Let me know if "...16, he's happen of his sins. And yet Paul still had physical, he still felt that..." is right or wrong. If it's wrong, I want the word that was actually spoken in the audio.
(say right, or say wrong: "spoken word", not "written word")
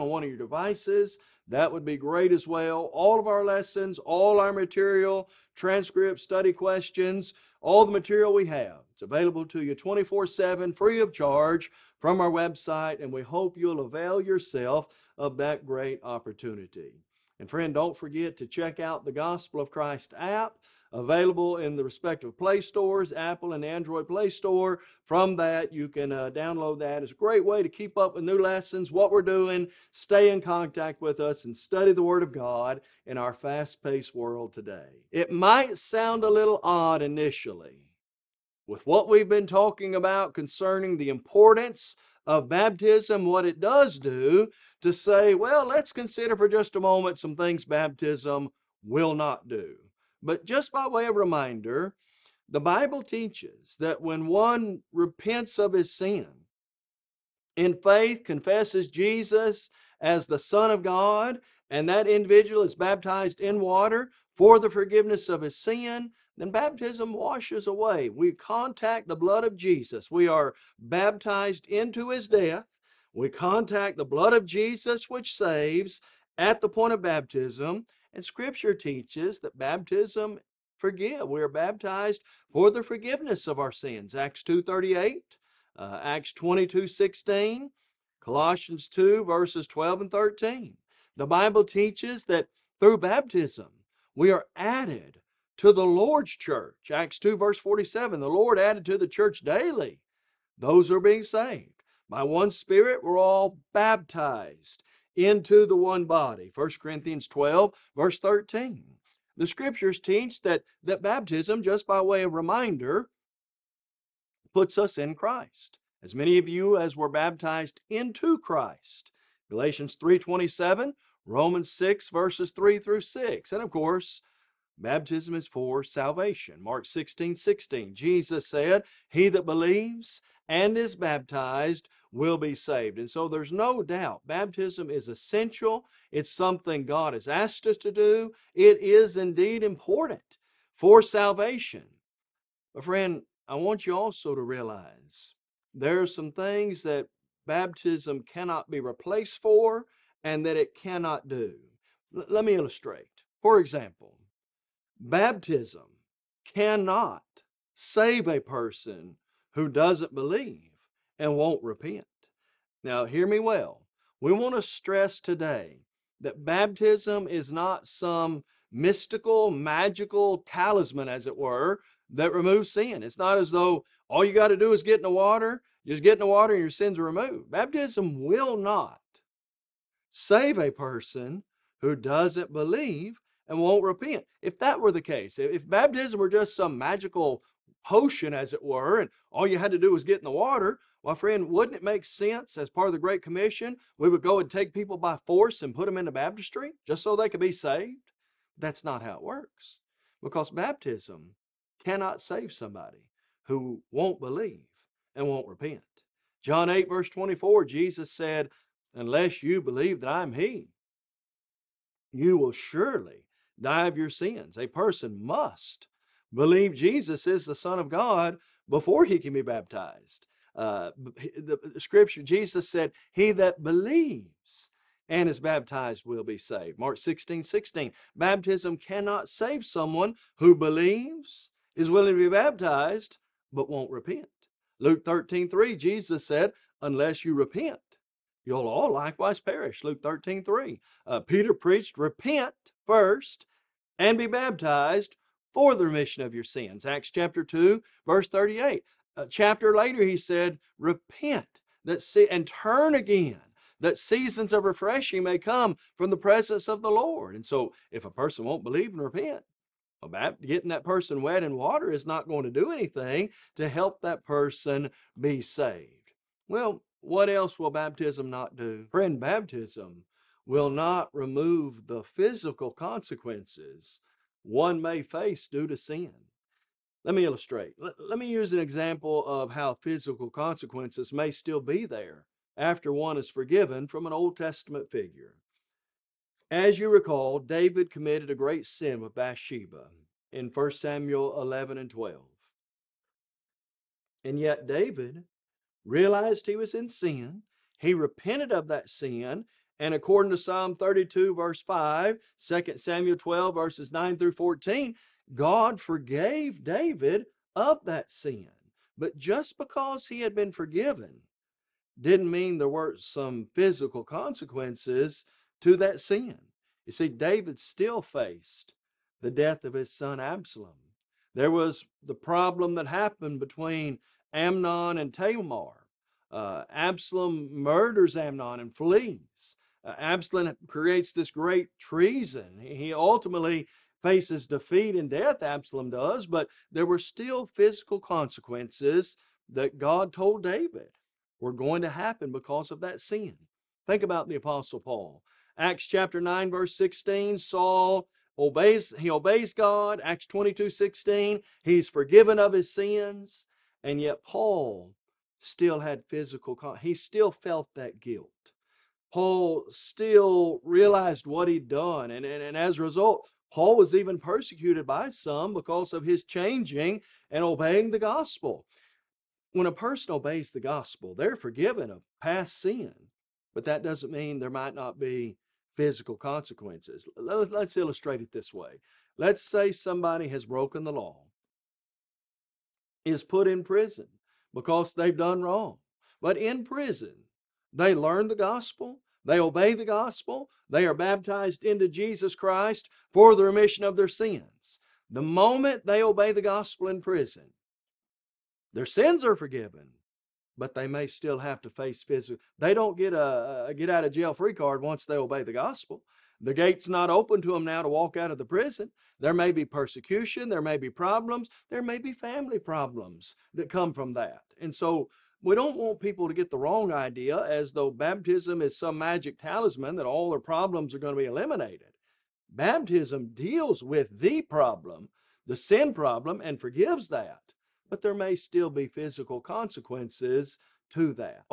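wrong: "forgiven", not "happen".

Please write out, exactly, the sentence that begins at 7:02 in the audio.
Baptism deals with the problem, the sin problem, and forgives that.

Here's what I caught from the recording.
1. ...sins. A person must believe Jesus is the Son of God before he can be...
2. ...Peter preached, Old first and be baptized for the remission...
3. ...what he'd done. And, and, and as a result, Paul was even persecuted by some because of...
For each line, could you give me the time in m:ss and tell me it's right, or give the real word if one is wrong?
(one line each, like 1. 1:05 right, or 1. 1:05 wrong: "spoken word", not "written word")
1. 3:34 right
2. 4:01 wrong: "Repent", not "Old"
3. 6:01 right.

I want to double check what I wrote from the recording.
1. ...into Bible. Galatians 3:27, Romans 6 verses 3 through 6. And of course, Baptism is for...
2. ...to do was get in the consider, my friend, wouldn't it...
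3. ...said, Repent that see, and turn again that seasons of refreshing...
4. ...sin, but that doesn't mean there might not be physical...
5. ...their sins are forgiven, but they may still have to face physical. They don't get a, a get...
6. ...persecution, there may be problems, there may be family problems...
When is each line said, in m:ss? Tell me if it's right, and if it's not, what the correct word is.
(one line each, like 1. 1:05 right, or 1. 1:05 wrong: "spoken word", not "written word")
1. 1:57 wrong: "Christ", not "Bible"
2. 3:09 wrong: "water", not "consider"
3. 4:10 right
4. 6:12 right
5. 6:38 right
6. 6:49 right.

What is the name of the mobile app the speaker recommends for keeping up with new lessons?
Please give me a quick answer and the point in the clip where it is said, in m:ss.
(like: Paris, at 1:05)
Gospel of Christ app, at 0:19.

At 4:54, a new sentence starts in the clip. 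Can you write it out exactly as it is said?
And yet, David realized he was in sin.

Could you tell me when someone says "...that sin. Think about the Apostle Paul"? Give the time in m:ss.
5:42.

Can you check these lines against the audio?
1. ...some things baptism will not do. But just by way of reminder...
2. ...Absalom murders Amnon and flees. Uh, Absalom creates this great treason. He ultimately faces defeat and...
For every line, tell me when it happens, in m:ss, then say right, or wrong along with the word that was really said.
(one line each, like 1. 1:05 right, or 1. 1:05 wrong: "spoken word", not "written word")
1. 0:47 right
2. 5:26 right.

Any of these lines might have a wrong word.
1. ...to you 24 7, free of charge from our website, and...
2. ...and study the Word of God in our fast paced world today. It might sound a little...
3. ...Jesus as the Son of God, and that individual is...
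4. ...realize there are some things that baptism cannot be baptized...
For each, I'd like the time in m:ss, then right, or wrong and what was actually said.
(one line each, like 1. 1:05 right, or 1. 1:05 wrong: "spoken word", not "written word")
1. 0:09 right
2. 0:31 right
3. 0:58 right
4. 2:24 wrong: "replaced", not "baptized".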